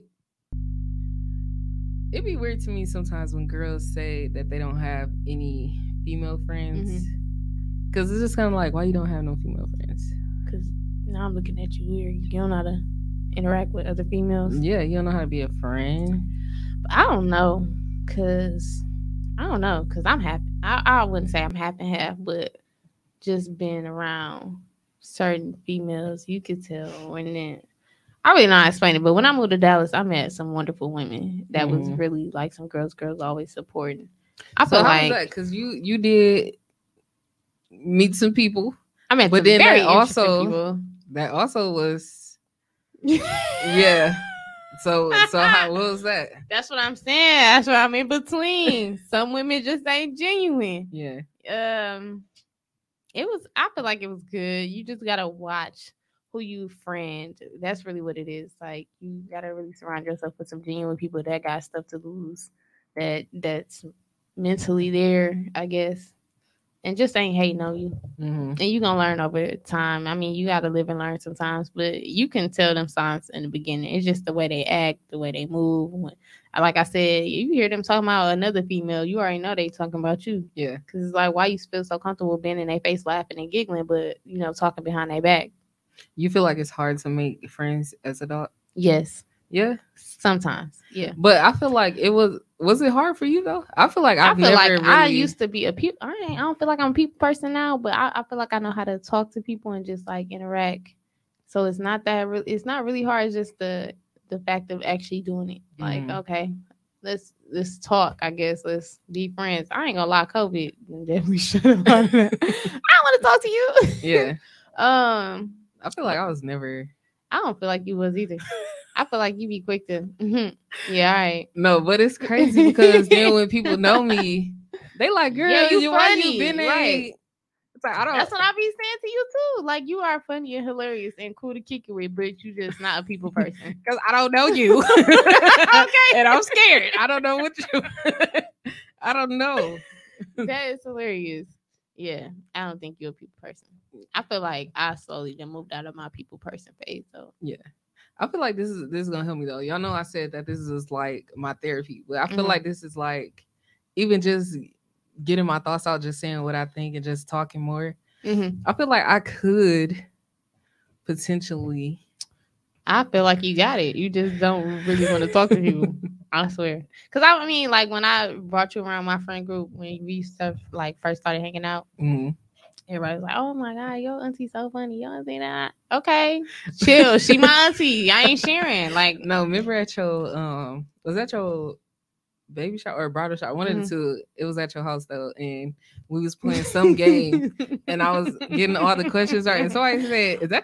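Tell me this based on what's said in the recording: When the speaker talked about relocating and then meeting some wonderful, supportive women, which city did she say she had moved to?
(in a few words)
Dallas.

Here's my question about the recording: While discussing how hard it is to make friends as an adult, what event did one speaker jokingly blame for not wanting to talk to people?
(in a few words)
COVID.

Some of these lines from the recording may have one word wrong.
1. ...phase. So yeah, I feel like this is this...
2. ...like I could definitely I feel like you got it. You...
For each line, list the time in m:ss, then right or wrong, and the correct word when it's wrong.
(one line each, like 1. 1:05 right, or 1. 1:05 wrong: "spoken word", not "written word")
1. 2:26 right
2. 2:38 wrong: "potentially", not "definitely".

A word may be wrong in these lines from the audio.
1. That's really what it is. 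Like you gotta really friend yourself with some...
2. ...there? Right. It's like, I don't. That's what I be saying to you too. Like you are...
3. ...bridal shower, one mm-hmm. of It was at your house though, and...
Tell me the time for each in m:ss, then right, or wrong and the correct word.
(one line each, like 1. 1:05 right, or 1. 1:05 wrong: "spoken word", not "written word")
1. 0:57 wrong: "surround", not "friend"
2. 2:06 right
3. 3:03 right.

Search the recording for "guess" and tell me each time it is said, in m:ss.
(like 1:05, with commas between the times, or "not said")
1:05, 1:48.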